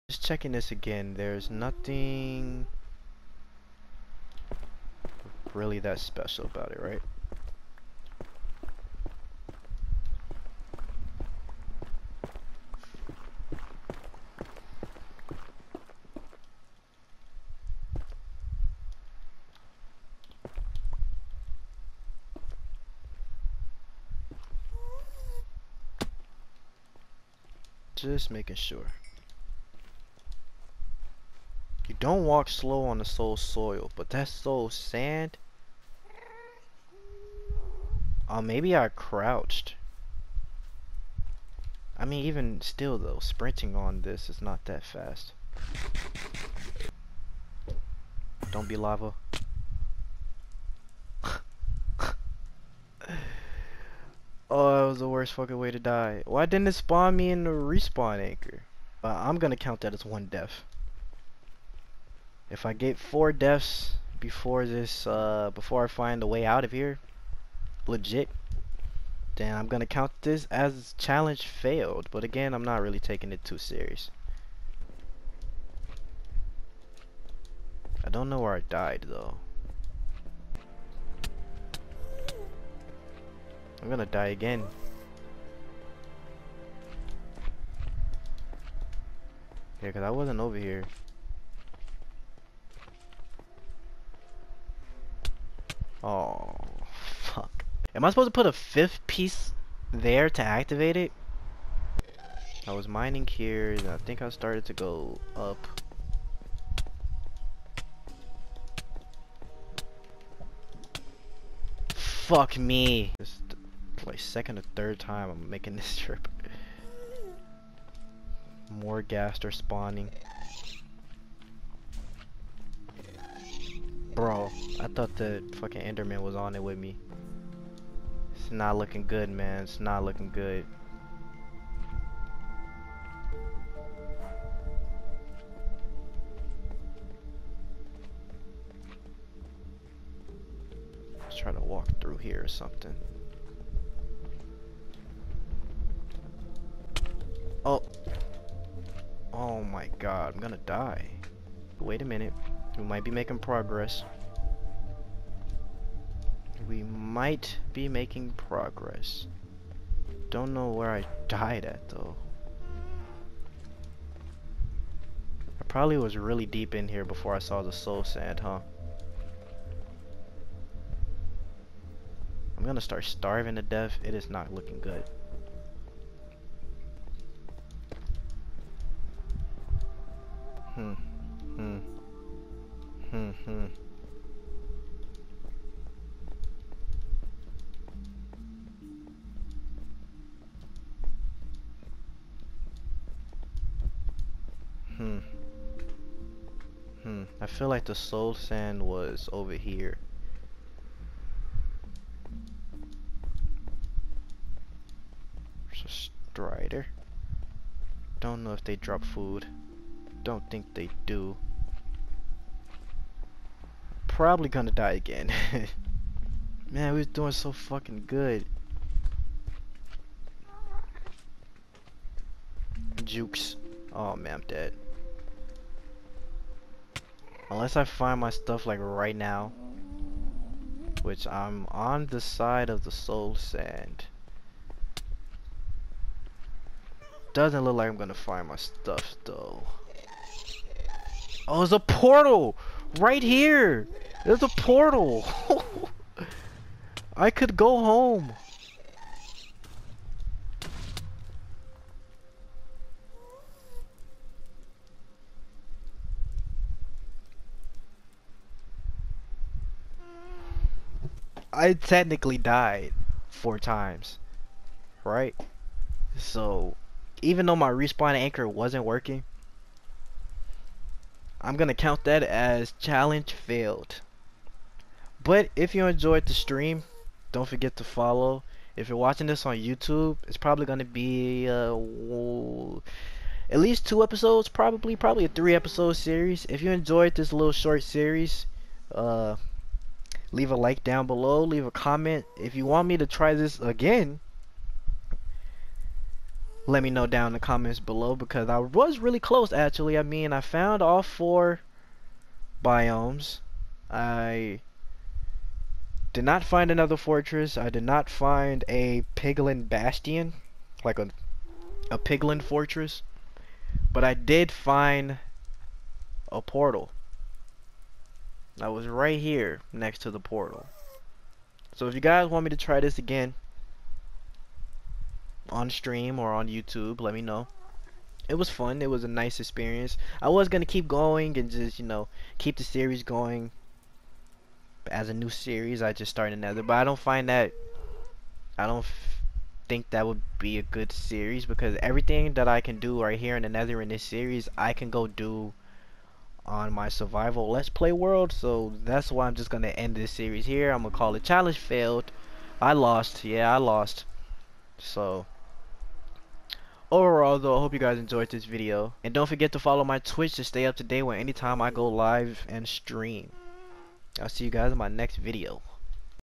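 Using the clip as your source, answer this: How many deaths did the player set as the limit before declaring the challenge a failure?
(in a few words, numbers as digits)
4.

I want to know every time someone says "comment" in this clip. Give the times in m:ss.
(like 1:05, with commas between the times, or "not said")
4:51, 4:57.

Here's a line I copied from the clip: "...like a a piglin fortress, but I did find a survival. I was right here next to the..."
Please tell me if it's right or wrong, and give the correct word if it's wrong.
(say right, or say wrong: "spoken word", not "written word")
wrong: "portal", not "survival".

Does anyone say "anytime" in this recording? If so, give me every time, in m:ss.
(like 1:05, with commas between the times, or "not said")
6:01.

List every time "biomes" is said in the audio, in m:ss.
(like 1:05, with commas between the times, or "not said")
5:02.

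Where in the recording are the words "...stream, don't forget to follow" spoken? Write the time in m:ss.
4:36.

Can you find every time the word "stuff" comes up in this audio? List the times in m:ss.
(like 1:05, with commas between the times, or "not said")
3:48, 3:58.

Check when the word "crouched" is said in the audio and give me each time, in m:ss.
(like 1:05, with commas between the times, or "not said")
0:38.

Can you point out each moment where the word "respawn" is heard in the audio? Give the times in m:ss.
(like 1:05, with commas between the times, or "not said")
0:57, 4:27.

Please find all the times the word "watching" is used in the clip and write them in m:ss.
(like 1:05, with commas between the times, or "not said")
4:38.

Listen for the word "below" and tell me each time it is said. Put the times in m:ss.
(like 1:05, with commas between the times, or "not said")
4:51, 4:57.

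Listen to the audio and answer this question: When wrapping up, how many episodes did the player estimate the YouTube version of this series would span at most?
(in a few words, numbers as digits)
3.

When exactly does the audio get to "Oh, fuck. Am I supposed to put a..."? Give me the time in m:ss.
1:36.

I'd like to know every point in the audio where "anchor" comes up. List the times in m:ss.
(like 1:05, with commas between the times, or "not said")
0:58, 4:28.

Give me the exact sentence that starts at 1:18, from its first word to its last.
I don't know where I died though.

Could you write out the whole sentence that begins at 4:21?
I technically died four times, right?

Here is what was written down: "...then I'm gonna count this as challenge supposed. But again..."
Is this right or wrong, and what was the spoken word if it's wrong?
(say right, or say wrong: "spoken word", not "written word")
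wrong: "failed", not "supposed".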